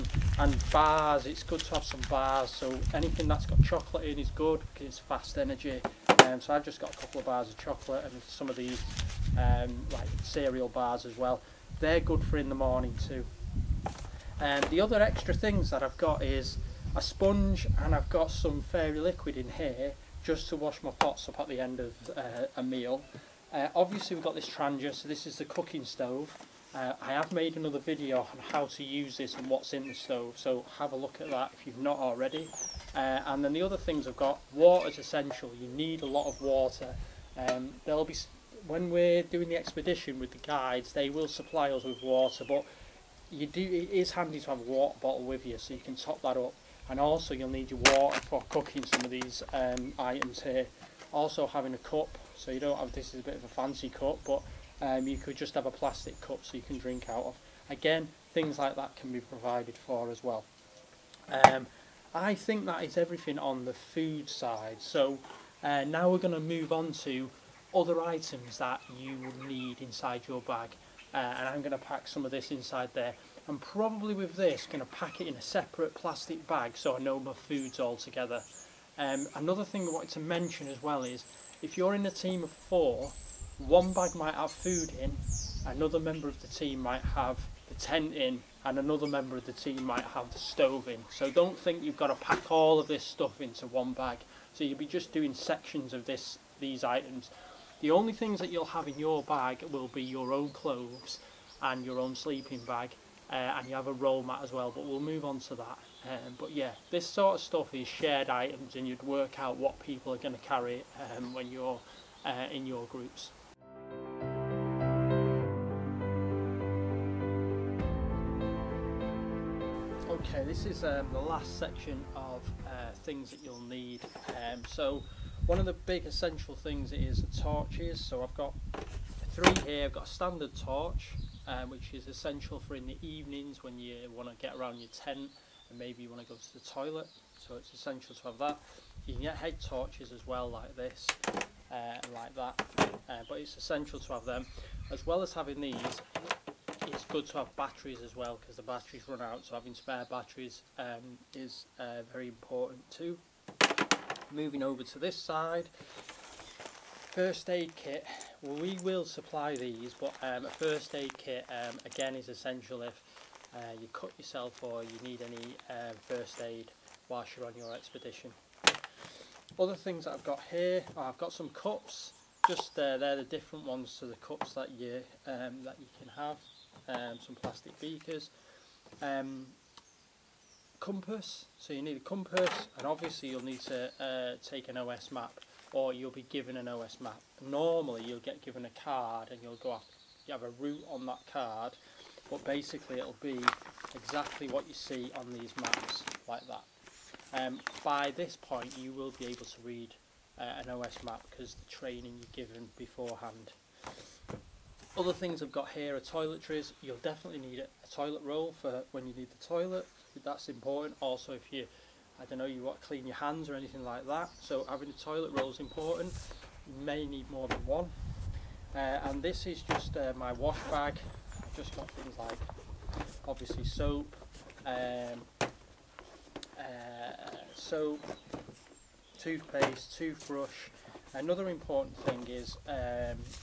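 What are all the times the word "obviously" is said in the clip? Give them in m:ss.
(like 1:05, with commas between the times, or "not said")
0:23, 3:02, 3:43.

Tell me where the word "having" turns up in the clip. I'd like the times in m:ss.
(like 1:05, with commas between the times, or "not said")
0:51, 2:25, 2:29, 3:34.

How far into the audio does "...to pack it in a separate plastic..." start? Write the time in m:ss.
1:14.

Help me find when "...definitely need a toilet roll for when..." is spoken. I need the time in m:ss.
3:26.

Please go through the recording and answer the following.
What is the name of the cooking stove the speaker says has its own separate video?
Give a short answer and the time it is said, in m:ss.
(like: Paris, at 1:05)
Trangia, at 0:24.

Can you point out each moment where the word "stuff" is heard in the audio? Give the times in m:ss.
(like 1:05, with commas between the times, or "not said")
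1:33, 1:47.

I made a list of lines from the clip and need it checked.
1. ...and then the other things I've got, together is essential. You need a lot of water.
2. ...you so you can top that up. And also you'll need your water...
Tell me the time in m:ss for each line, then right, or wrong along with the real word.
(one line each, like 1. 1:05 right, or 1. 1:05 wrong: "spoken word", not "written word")
1. 0:33 wrong: "water", not "together"
2. 0:45 right.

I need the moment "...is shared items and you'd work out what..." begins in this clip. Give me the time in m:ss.
1:47.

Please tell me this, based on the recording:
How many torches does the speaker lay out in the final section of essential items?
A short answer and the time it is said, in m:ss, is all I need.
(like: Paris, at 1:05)
3, at 2:09.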